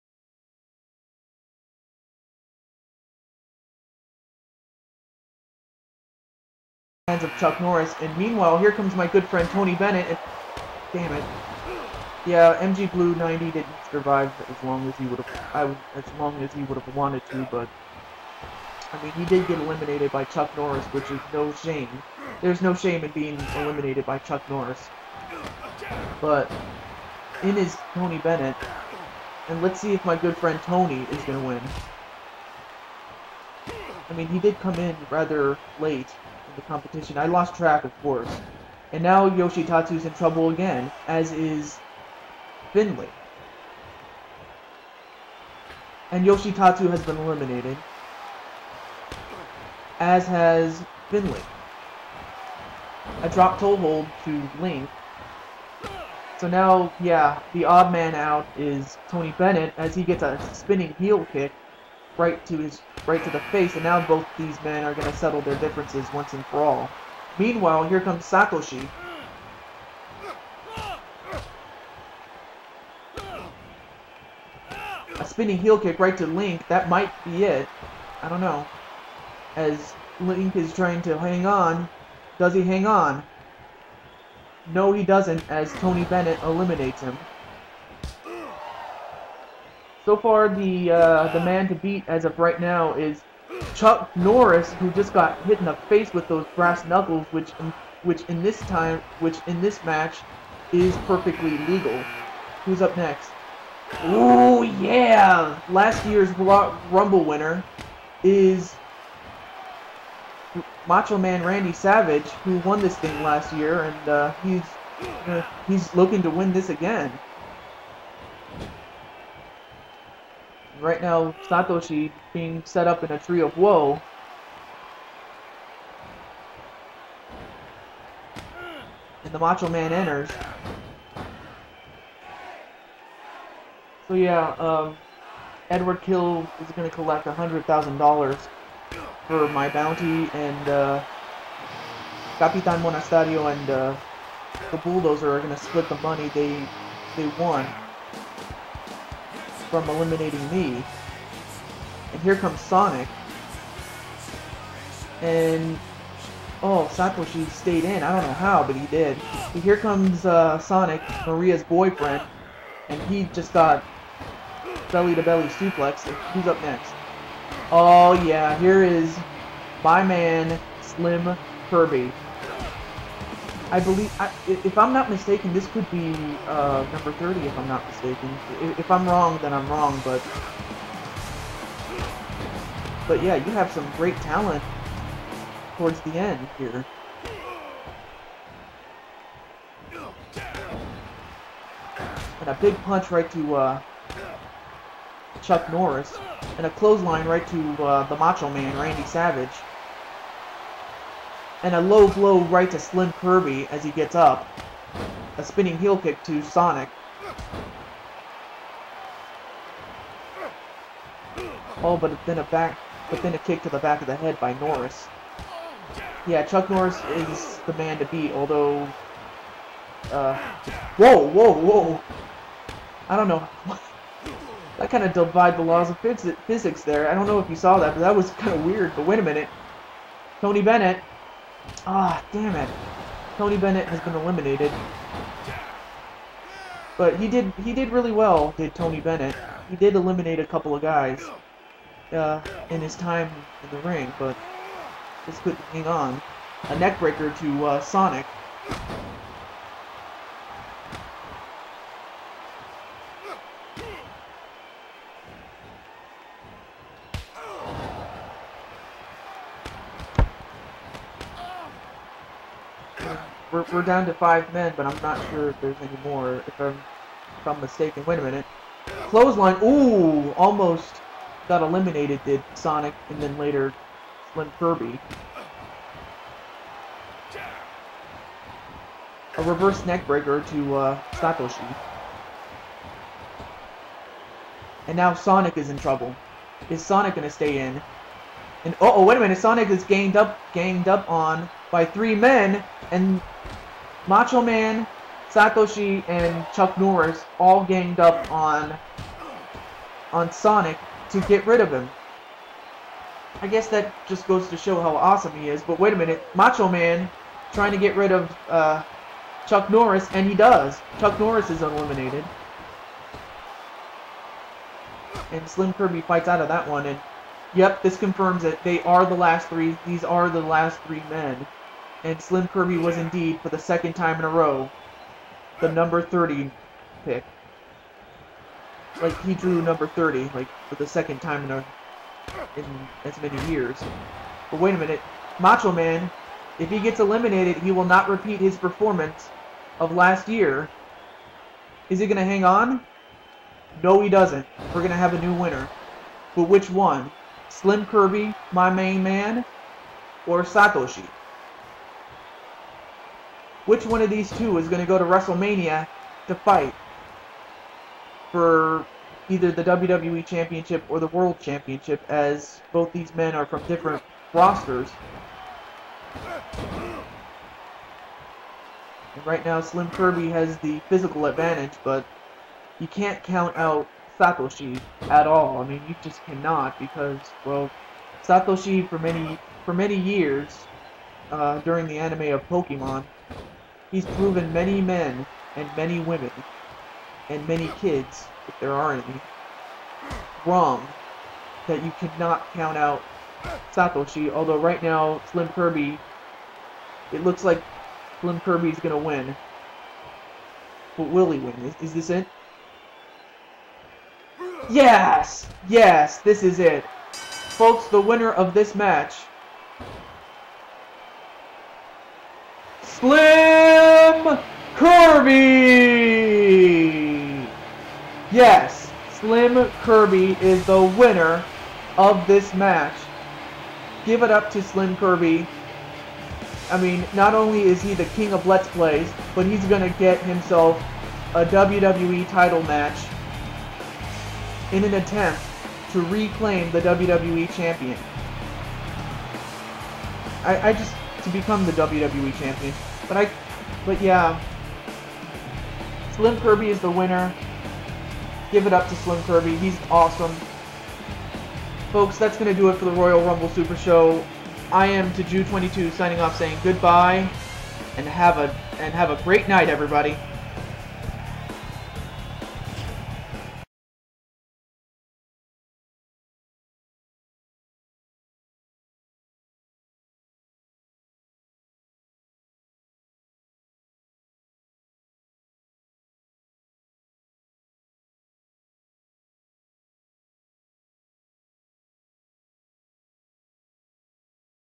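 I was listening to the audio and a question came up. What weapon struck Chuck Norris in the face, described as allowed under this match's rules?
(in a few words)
Brass knuckles.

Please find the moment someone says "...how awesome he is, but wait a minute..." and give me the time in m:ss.
5:04.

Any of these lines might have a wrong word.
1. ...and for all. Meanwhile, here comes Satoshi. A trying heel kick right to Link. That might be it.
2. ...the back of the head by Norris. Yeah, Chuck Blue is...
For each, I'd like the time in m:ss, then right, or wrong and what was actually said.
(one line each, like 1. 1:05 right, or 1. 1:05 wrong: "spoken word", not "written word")
1. 1:06 wrong: "spinning", not "trying"
2. 3:33 wrong: "Norris", not "Blue".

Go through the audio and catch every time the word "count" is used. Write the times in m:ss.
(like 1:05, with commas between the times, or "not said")
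6:13, 6:32.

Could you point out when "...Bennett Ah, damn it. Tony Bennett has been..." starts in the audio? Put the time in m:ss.
3:50.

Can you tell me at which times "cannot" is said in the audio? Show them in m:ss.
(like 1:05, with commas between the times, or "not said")
6:16, 6:31.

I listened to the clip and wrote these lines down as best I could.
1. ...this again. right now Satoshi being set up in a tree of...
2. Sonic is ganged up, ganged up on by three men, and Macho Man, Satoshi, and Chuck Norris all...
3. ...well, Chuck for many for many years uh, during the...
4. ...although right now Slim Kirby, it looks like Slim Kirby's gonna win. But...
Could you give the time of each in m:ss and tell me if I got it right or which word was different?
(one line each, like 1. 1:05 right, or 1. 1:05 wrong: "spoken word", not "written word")
1. 1:56 right
2. 4:49 right
3. 6:17 wrong: "Satoshi", not "Chuck"
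4. 6:34 right.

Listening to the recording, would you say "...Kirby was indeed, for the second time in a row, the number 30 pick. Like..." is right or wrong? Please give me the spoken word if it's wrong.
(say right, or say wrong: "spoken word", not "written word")
right.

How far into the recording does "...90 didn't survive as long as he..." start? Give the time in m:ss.
0:13.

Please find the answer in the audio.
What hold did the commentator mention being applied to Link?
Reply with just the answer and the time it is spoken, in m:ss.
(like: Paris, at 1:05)
Dropped toe hold, at 0:53.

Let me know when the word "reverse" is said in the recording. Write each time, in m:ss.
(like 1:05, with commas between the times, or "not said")
4:39.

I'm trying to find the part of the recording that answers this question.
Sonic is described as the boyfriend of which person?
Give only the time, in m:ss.
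2:41.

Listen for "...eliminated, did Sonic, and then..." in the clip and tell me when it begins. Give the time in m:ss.
4:31.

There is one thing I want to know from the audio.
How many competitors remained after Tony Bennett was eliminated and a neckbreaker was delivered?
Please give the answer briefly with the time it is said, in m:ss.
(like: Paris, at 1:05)
5, at 4:24.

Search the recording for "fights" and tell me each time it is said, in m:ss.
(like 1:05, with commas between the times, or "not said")
5:16, 5:56.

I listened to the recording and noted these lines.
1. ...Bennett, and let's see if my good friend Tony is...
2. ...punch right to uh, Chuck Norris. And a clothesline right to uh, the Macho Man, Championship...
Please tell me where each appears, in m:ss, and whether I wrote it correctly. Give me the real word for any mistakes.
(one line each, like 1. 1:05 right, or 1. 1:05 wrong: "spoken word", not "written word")
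1. 0:28 right
2. 3:12 wrong: "Randy", not "Championship".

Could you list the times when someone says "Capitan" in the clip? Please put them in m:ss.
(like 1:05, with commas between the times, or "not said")
2:22.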